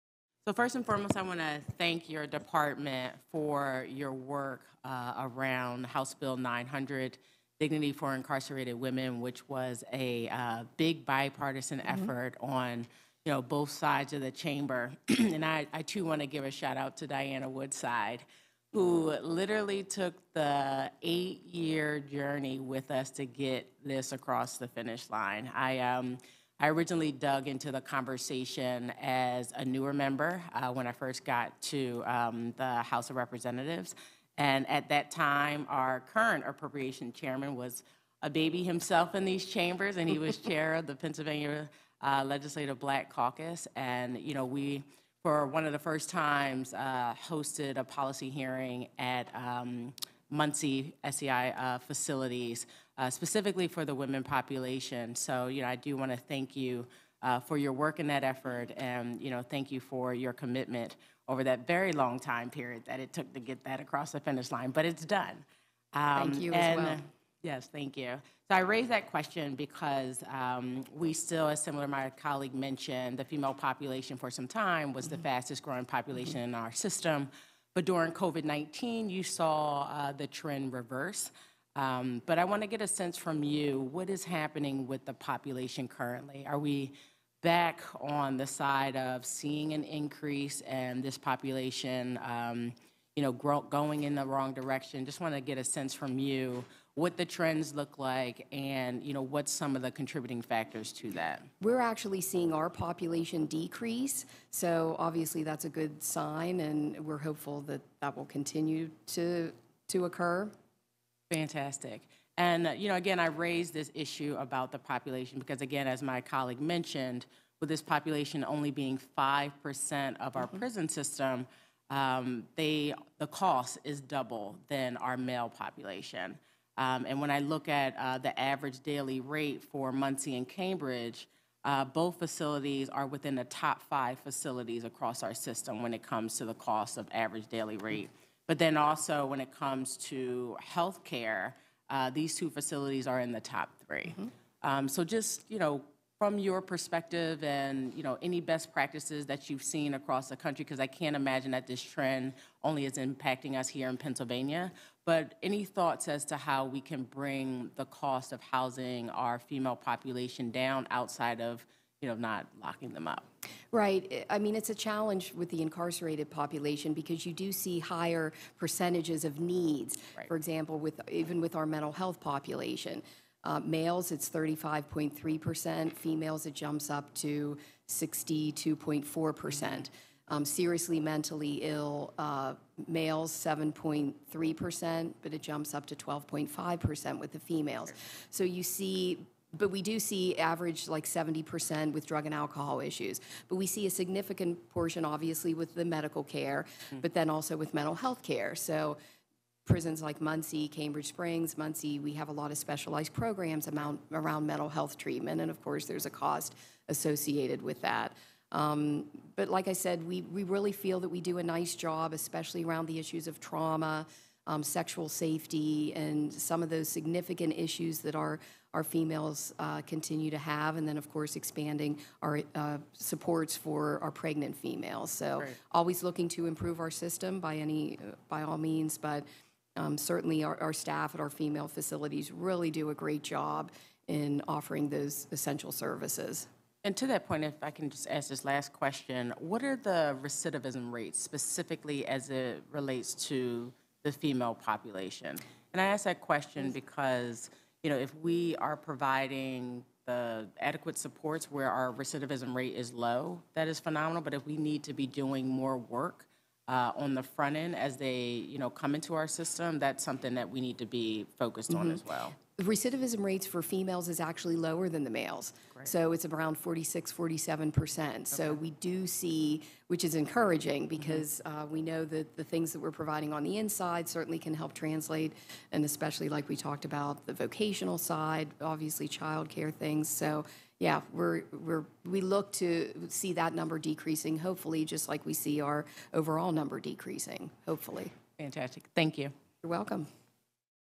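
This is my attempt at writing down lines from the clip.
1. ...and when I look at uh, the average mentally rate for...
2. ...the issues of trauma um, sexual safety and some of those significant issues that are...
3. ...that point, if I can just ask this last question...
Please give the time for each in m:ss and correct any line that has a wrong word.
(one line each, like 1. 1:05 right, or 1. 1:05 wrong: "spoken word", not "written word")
1. 2:07 wrong: "daily", not "mentally"
2. 3:32 right
3. 3:57 right.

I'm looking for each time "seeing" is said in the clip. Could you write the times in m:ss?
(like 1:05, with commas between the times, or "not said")
1:29, 1:42.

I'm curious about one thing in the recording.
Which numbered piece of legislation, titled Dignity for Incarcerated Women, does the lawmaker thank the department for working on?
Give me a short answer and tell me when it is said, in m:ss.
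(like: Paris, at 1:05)
House Bill 900, at 0:05.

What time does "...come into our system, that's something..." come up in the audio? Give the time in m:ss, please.
4:18.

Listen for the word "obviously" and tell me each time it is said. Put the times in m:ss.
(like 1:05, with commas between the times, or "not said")
1:44, 3:15, 4:38.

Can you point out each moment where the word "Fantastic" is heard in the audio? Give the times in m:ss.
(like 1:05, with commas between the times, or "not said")
1:51, 4:48.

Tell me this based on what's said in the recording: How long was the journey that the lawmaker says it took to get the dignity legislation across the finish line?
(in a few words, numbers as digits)
8 years.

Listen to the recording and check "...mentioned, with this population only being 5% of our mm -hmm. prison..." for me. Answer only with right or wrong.
right.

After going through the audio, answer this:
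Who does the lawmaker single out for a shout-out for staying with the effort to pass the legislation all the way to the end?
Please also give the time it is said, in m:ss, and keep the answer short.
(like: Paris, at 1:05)
Diana Woodside, at 0:17.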